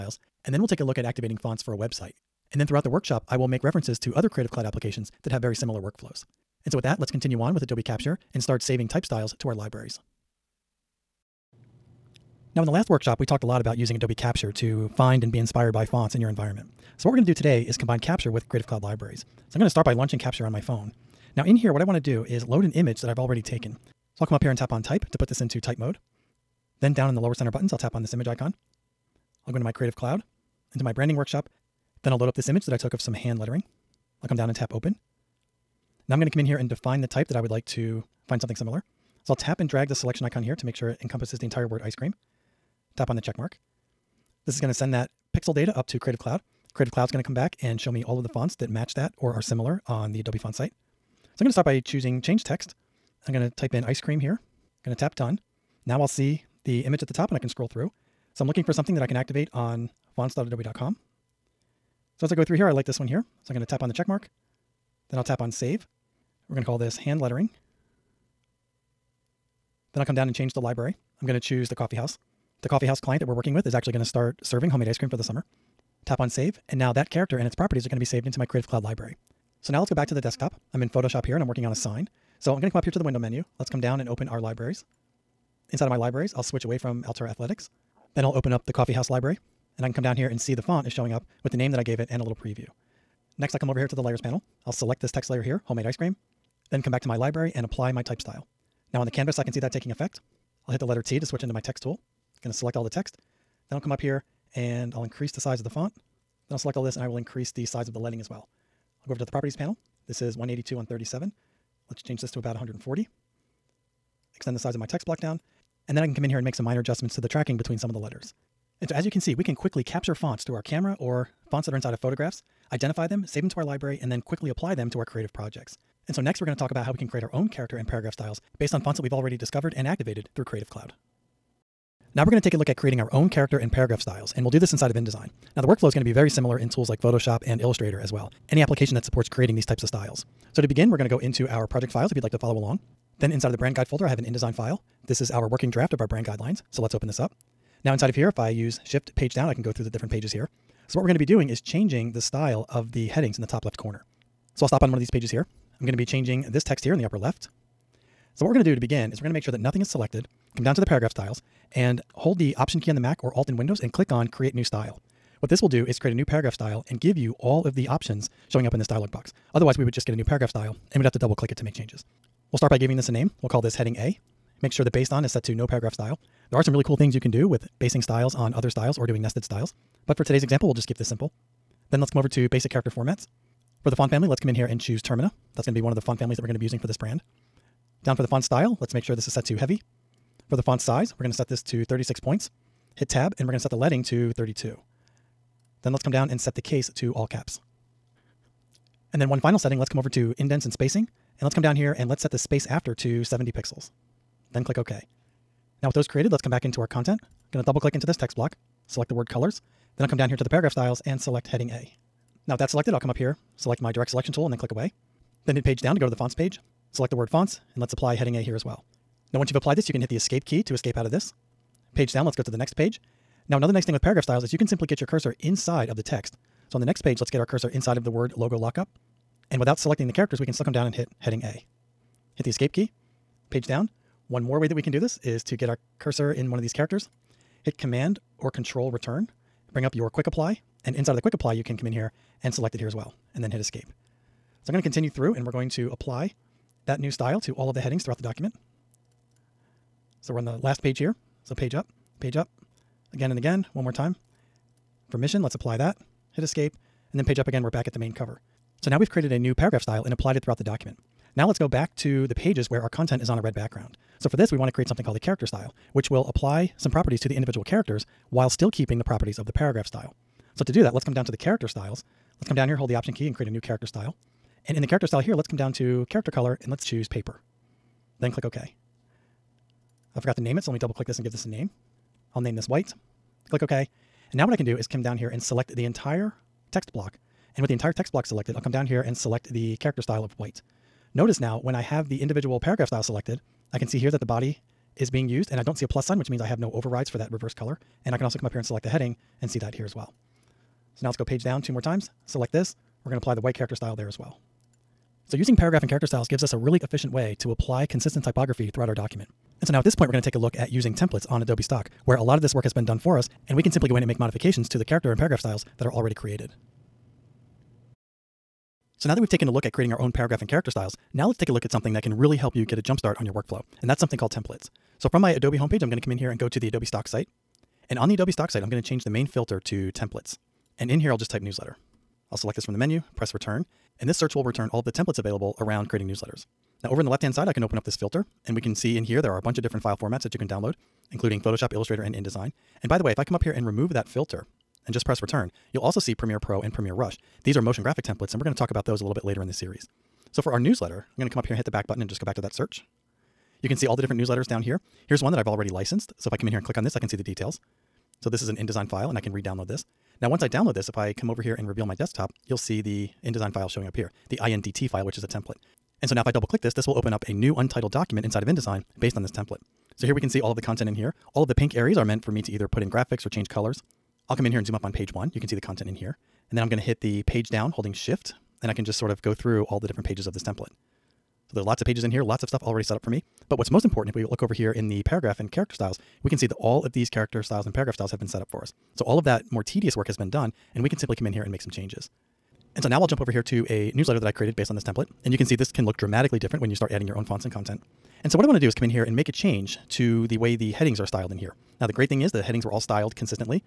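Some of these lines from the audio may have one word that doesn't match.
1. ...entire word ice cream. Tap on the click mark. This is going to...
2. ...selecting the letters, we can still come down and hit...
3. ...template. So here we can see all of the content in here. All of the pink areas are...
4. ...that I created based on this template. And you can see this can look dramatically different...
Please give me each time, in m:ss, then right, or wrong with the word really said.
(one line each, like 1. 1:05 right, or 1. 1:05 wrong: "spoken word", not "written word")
1. 0:41 wrong: "check", not "click"
2. 3:49 wrong: "characters", not "letters"
3. 6:09 right
4. 6:34 right.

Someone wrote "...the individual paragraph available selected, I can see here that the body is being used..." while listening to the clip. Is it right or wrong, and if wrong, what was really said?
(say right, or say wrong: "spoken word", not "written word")
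wrong: "style", not "available".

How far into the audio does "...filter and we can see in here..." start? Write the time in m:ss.
5:37.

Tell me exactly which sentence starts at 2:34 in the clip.
So I'll stop on one of these pages here.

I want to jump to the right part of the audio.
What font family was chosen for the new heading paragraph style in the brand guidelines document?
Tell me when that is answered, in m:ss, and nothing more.
3:05.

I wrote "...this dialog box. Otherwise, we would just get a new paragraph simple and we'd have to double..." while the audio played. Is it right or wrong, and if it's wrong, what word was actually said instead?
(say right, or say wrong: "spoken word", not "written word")
wrong: "style", not "simple".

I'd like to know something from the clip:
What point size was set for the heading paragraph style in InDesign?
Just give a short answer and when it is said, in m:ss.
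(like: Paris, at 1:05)
36 points, at 3:11.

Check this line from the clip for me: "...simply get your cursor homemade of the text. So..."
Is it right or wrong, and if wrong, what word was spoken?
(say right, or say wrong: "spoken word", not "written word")
wrong: "inside", not "homemade".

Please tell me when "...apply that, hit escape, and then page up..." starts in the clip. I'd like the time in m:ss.
4:15.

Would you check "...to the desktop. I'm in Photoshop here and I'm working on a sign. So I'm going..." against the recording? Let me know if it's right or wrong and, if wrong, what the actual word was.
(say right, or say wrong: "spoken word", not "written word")
right.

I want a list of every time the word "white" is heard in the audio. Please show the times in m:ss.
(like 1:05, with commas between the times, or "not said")
4:42, 4:50, 5:03.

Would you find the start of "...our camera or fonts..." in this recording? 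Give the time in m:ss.
2:00.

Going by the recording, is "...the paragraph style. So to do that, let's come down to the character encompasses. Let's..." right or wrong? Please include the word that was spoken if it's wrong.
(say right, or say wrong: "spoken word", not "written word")
wrong: "styles", not "encompasses".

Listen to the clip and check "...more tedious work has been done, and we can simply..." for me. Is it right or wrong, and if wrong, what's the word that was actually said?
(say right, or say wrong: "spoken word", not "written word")
right.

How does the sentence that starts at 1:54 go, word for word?
Extend the size of my text block down.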